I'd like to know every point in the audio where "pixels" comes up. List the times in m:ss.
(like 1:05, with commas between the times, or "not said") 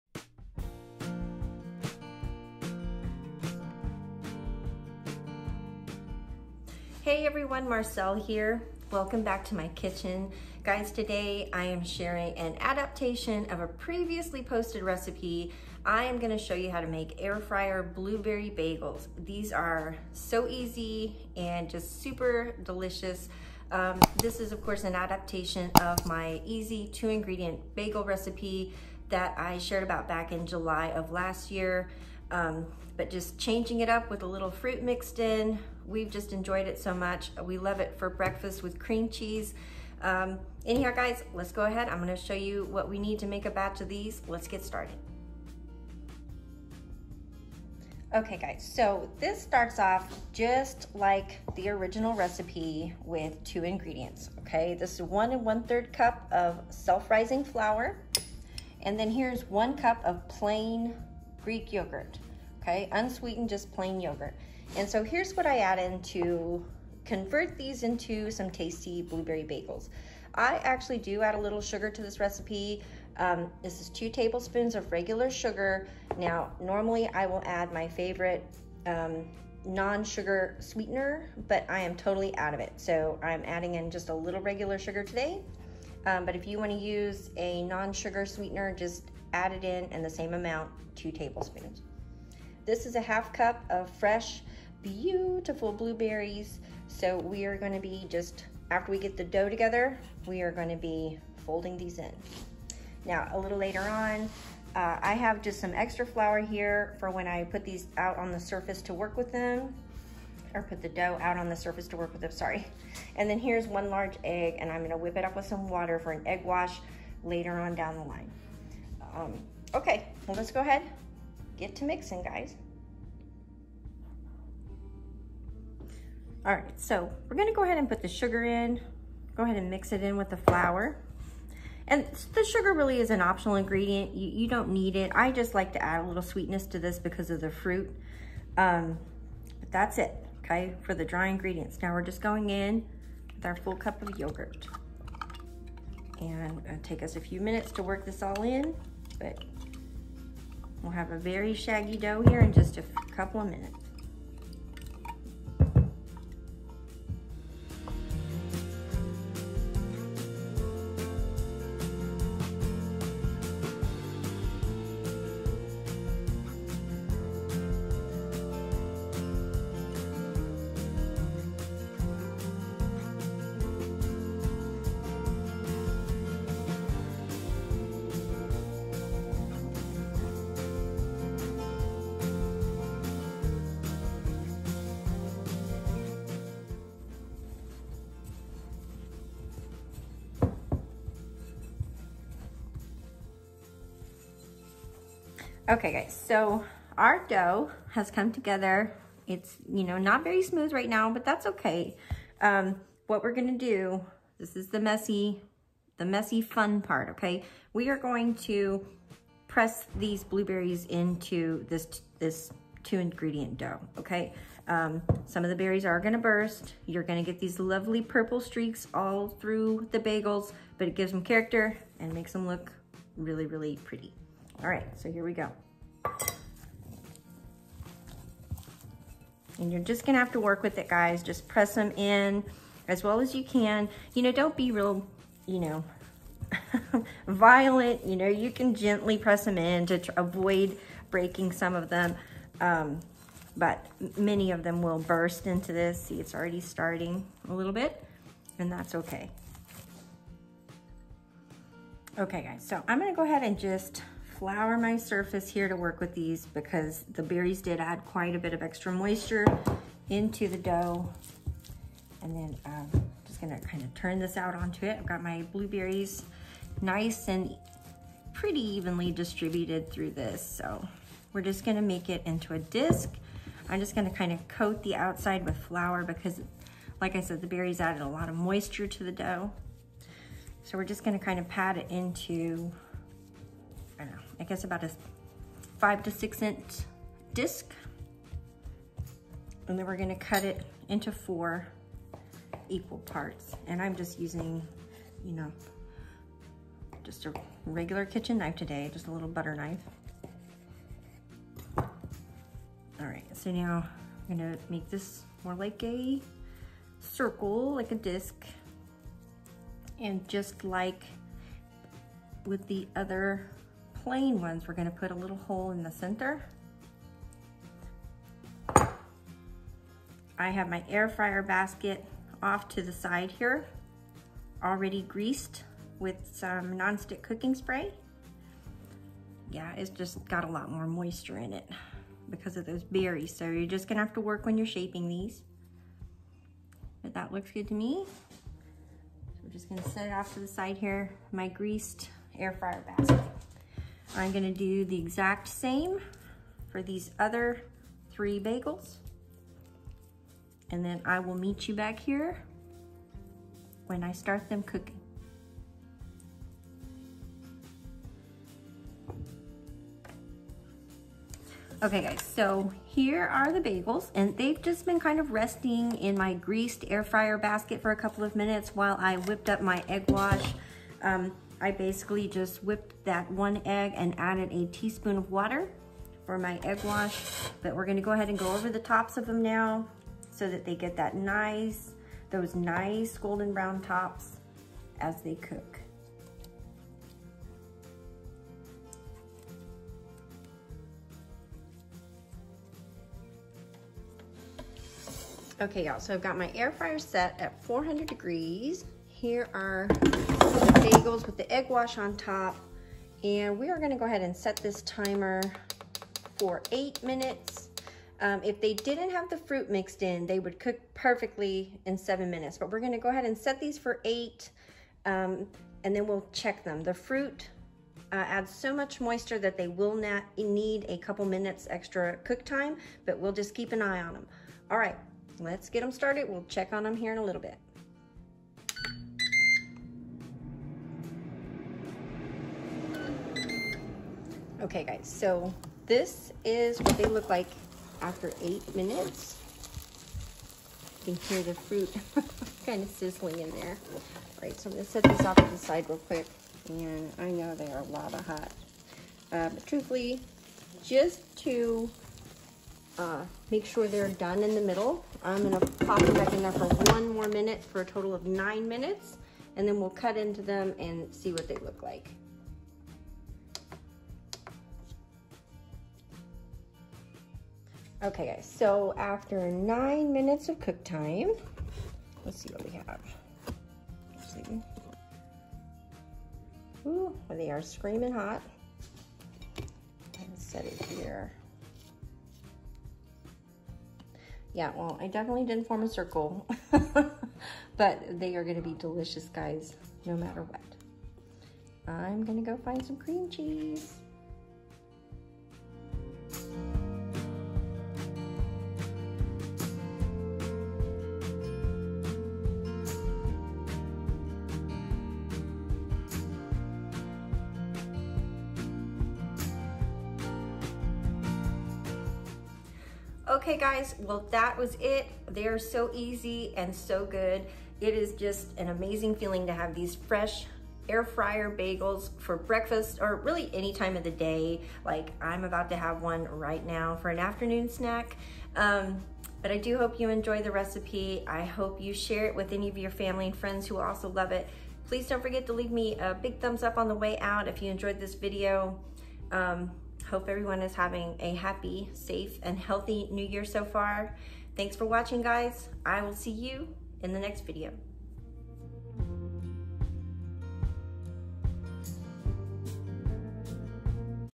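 not said.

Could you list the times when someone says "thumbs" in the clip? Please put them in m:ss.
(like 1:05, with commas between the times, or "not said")
8:56.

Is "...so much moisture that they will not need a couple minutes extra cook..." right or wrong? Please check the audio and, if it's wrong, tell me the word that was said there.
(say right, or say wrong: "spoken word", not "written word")
right.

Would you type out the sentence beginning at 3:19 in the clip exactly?
It's, you know, not very smooth right now, but that's okay.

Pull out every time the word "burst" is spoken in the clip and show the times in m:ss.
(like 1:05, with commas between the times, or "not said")
3:36, 4:04.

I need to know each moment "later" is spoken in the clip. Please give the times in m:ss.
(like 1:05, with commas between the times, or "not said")
1:43, 1:57.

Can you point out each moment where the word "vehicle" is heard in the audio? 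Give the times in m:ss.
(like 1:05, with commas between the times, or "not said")
not said.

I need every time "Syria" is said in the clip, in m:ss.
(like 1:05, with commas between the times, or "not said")
not said.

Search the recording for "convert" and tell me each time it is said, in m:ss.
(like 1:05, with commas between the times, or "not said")
1:07.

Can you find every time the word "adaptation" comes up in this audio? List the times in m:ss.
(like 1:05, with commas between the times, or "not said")
0:12, 0:24.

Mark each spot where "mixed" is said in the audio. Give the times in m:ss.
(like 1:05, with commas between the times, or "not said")
0:34, 6:49.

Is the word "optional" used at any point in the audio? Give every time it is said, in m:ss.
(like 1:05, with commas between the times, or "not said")
2:13.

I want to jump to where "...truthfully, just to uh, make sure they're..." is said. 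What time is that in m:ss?
7:29.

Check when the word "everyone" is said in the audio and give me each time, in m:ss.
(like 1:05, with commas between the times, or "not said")
0:07, 9:00.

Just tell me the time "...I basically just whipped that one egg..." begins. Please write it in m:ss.
6:11.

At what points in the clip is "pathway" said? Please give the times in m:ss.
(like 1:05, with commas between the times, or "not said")
not said.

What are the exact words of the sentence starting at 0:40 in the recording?
Um, anyhow, guys, let's go ahead.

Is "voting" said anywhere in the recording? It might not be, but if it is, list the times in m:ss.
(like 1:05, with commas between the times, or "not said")
not said.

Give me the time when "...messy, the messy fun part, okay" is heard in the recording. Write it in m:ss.
3:24.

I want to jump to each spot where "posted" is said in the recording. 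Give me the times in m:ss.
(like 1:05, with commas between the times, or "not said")
0:14.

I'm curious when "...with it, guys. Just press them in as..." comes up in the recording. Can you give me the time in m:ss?
3:50.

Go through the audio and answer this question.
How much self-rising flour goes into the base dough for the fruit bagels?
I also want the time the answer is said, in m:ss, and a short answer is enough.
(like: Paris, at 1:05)
1 1/3 cups, at 0:55.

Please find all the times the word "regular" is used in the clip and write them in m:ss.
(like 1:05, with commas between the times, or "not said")
1:14, 1:24, 4:57.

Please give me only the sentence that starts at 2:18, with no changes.
Um, but that's it, okay, for the dry ingredients.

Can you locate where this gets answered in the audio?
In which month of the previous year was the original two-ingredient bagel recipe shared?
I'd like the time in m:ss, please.
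0:30.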